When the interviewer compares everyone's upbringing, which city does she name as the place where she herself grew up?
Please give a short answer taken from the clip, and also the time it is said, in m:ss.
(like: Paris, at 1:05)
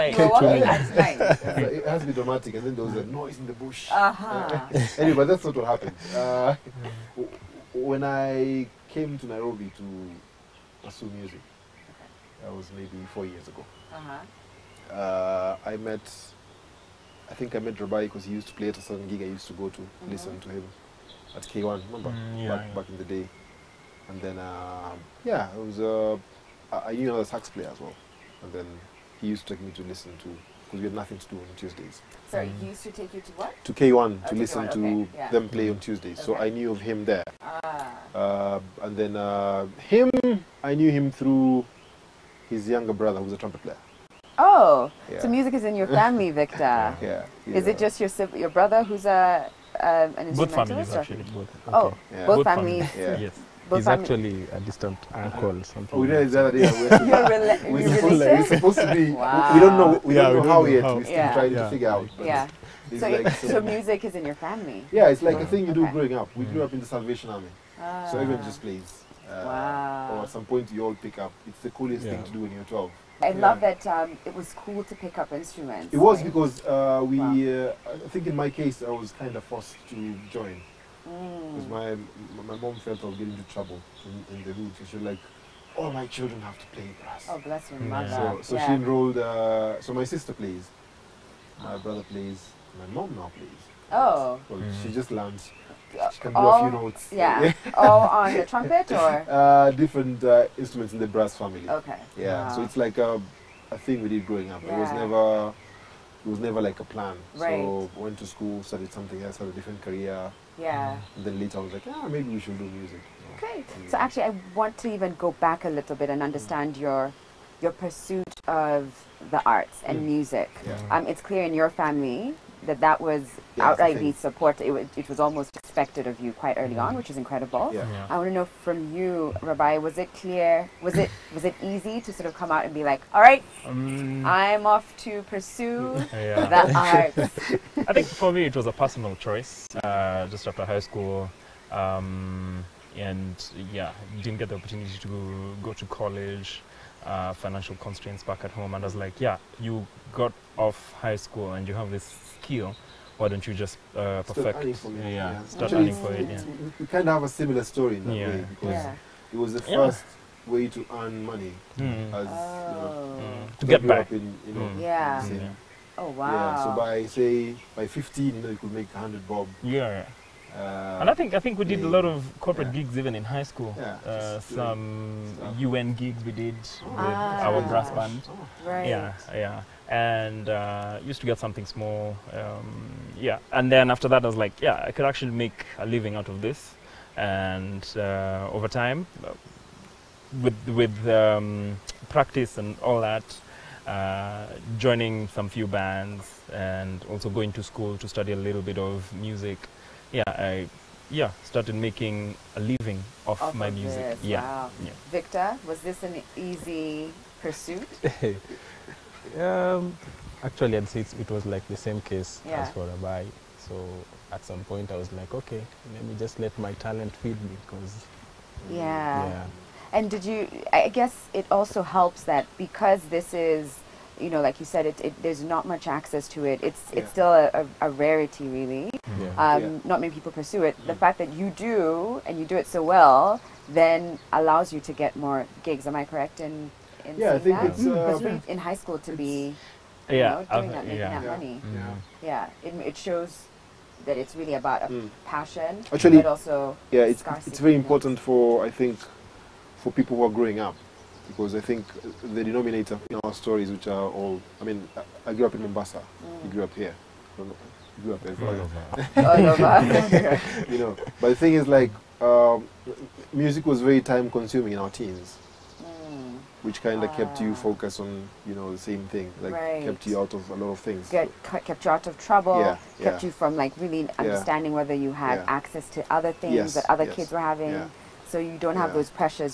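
Mombasa, at 4:15.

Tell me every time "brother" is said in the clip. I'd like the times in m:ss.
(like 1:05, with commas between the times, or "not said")
0:42, 0:48, 1:31.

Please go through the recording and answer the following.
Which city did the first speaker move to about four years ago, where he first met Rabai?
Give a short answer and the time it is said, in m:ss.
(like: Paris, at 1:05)
Nairobi, at 0:09.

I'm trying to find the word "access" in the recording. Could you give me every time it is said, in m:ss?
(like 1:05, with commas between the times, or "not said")
3:45, 4:35.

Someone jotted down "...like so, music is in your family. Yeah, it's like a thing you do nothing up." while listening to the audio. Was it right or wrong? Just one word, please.
wrong.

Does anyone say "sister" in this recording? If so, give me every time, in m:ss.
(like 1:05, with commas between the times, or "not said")
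1:30.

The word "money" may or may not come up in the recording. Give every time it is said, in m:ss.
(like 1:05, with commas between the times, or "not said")
2:41, 4:01.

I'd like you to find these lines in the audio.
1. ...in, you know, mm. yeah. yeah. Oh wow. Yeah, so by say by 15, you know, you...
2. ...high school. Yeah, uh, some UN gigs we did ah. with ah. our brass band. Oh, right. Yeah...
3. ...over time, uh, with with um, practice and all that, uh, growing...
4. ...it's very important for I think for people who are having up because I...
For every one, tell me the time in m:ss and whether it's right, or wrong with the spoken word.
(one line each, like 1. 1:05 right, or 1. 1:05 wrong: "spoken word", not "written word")
1. 2:44 right
2. 2:53 right
3. 3:08 wrong: "joining", not "growing"
4. 4:07 wrong: "growing", not "having".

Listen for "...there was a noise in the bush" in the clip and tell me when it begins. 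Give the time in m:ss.
0:02.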